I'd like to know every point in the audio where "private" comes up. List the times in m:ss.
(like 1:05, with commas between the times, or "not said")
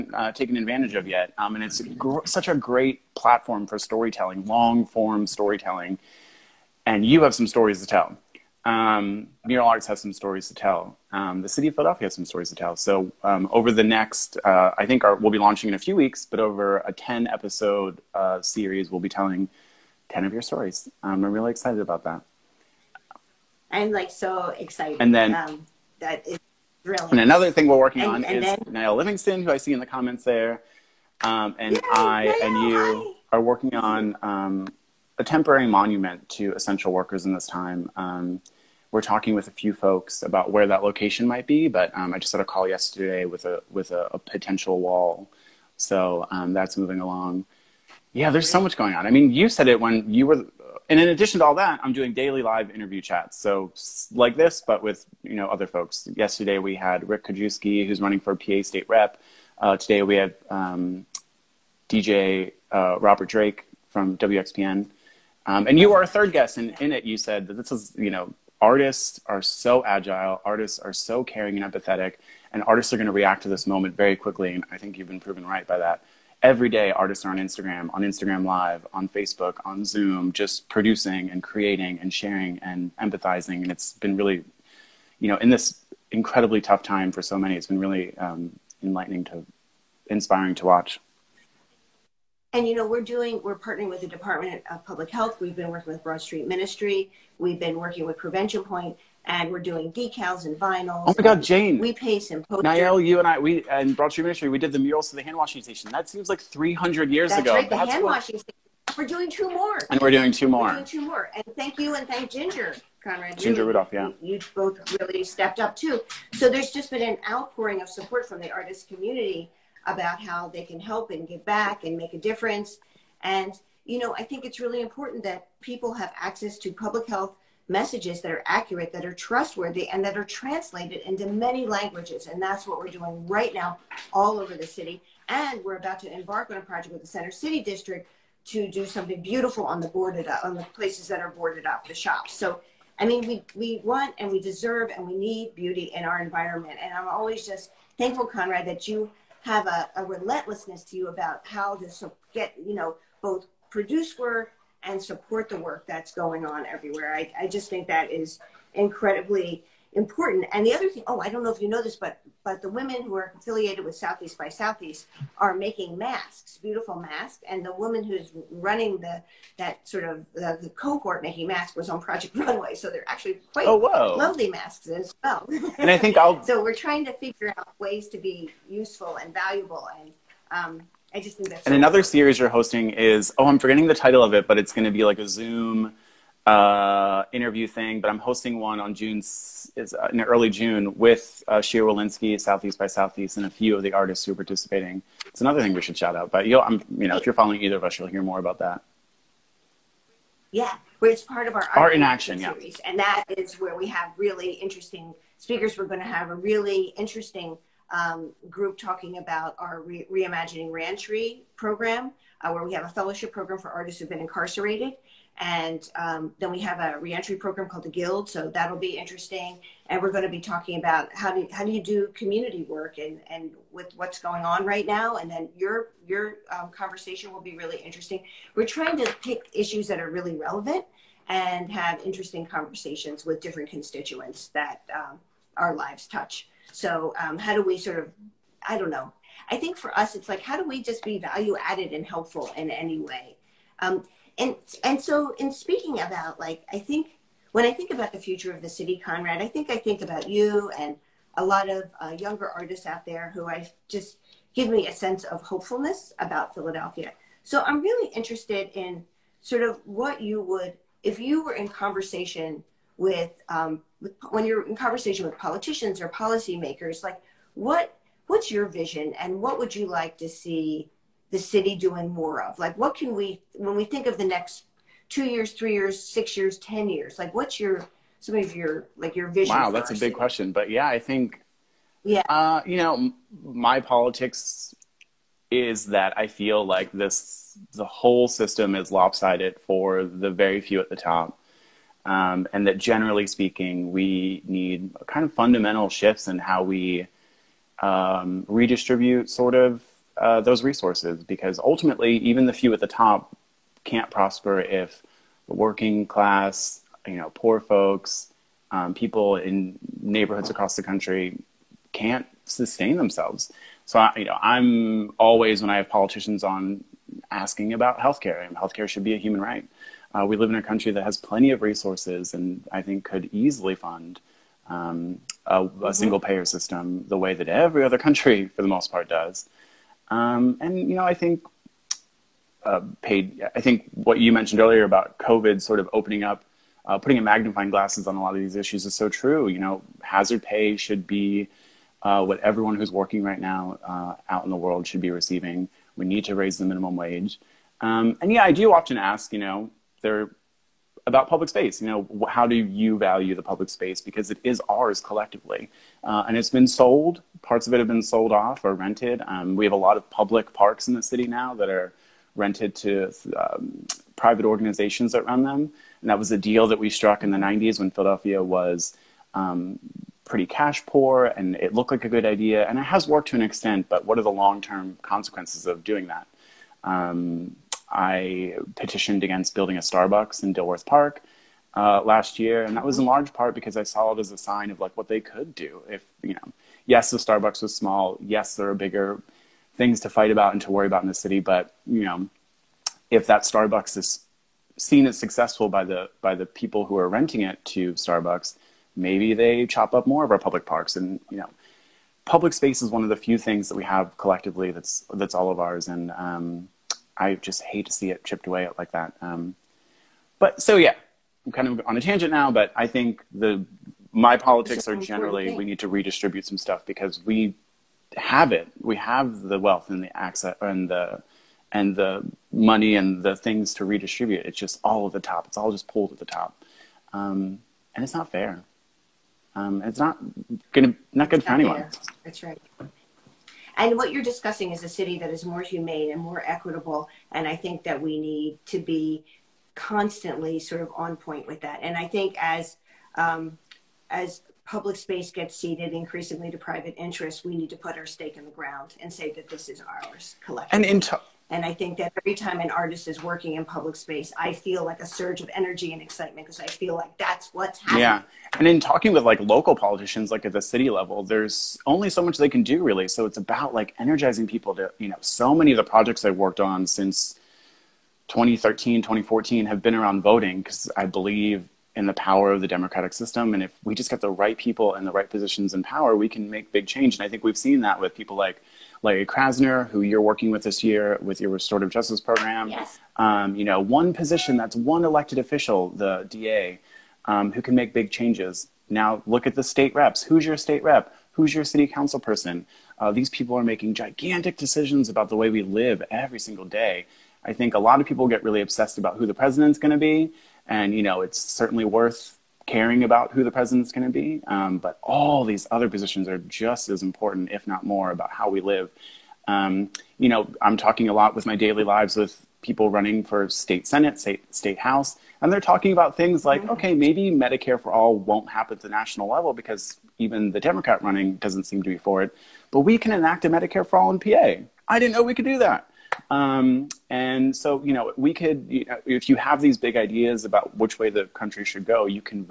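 6:04, 7:26.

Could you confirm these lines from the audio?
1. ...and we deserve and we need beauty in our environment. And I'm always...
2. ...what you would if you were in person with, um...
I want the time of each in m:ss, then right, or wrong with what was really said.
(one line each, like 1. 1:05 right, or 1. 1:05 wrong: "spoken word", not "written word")
1. 2:24 right
2. 4:19 wrong: "conversation", not "person".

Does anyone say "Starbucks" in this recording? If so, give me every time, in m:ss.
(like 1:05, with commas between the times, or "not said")
6:19, 6:27, 6:33, 6:37.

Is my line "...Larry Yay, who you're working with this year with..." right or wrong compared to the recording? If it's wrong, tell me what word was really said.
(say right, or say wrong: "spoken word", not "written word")
wrong: "Krasner", not "Yay".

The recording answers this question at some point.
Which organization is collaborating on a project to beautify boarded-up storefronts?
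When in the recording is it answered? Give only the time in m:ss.
2:17.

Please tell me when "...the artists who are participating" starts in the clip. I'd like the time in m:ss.
3:13.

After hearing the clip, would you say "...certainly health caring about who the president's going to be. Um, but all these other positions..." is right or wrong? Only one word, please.
wrong.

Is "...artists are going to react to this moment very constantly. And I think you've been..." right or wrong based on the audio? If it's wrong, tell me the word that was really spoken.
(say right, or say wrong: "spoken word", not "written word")
wrong: "quickly", not "constantly".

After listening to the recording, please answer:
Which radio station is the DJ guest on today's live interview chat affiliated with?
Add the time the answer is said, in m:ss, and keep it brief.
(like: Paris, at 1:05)
WXPN, at 1:04.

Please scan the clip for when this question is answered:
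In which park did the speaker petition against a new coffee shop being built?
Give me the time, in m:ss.
6:20.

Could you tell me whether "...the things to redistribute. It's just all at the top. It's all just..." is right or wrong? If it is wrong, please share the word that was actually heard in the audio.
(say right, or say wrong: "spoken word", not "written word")
right.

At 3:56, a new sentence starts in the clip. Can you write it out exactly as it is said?
So um, how do we sort of I don't know.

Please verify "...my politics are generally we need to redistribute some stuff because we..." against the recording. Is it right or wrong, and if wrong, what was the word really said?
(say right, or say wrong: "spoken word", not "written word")
right.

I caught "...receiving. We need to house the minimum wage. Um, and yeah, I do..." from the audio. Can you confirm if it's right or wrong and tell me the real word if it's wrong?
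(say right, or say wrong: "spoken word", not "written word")
wrong: "raise", not "house".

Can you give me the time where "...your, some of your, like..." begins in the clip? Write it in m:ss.
4:37.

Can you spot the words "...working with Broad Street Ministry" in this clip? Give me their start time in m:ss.
1:35.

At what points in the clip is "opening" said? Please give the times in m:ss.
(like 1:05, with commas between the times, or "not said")
5:35.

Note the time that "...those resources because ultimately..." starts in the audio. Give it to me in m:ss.
5:00.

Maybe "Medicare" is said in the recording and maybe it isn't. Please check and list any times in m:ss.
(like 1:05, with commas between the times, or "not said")
8:37, 8:43.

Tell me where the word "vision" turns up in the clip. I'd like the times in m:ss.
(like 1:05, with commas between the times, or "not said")
4:28, 4:39.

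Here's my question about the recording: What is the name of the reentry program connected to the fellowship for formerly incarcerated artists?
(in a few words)
the Guild.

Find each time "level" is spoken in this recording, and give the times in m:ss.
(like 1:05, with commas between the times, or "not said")
7:40, 8:39.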